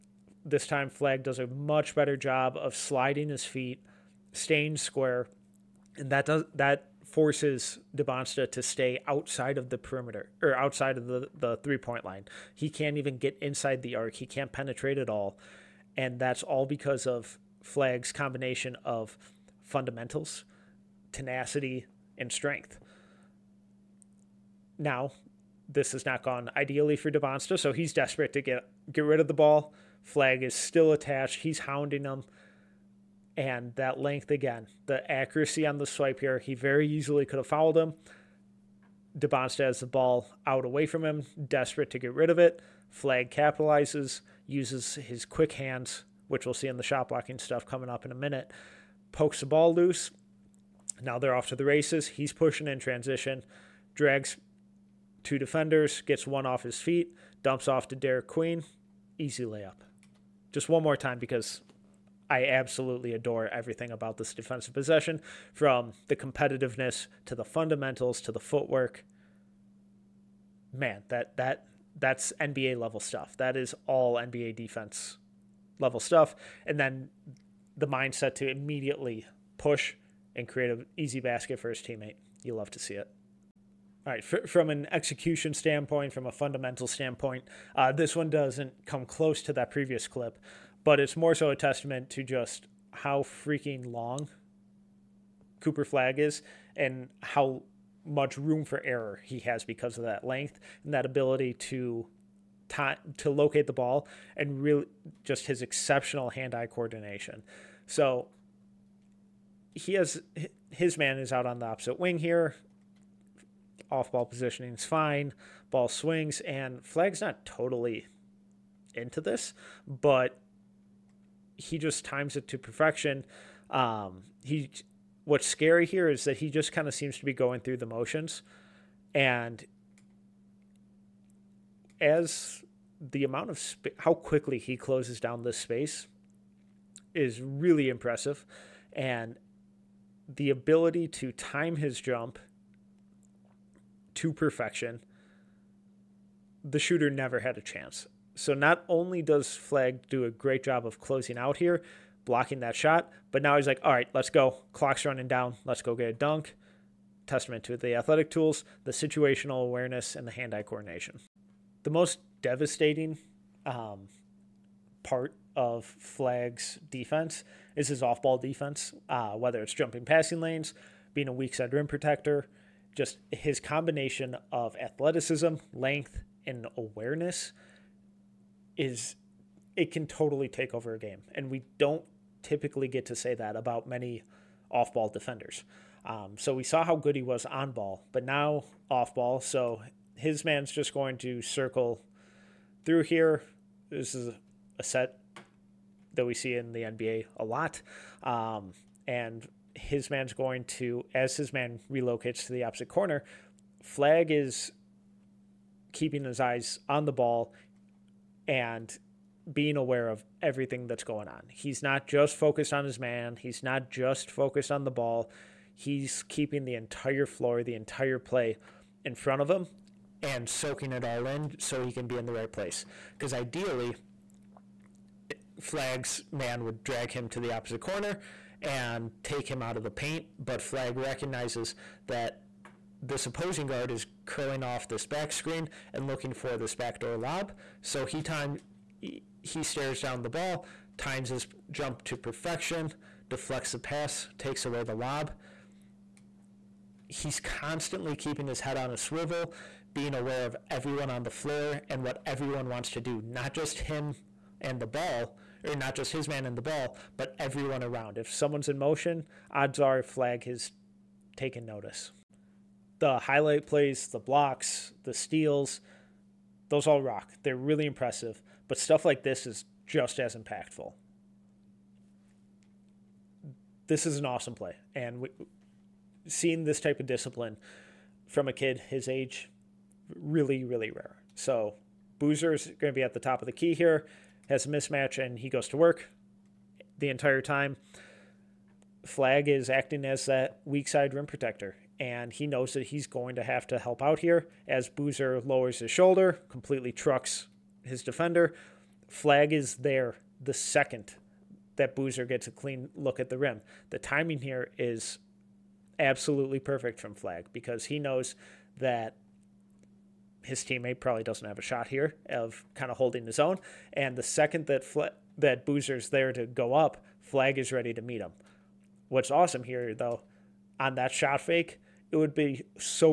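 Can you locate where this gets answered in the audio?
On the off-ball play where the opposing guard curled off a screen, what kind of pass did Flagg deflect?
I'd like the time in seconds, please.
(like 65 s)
236 s.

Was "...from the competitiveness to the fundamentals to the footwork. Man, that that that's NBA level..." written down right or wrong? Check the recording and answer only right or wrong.
right.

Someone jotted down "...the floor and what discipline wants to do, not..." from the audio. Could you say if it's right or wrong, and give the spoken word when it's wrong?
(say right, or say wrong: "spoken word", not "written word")
wrong: "everyone", not "discipline".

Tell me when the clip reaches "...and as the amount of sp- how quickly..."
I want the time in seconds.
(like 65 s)
129 s.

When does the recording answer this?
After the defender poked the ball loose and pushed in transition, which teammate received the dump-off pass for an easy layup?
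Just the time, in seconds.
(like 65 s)
57 s.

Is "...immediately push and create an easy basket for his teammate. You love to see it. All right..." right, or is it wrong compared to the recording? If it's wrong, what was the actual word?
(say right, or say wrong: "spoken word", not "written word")
right.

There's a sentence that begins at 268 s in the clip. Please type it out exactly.
But stuff like this is just as impactful.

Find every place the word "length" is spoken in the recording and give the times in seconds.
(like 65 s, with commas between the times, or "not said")
33 s, 100 s, 175 s.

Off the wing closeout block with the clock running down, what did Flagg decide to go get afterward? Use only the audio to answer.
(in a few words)
a dunk.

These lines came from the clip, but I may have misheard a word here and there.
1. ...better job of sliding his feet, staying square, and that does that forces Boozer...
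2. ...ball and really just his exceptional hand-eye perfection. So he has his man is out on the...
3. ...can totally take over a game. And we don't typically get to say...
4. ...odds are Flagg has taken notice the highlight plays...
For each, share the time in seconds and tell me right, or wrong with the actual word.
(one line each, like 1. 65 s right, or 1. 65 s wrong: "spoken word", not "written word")
1. 1 s wrong: "Dybantsa", not "Boozer"
2. 103 s wrong: "coordination", not "perfection"
3. 179 s right
4. 259 s right.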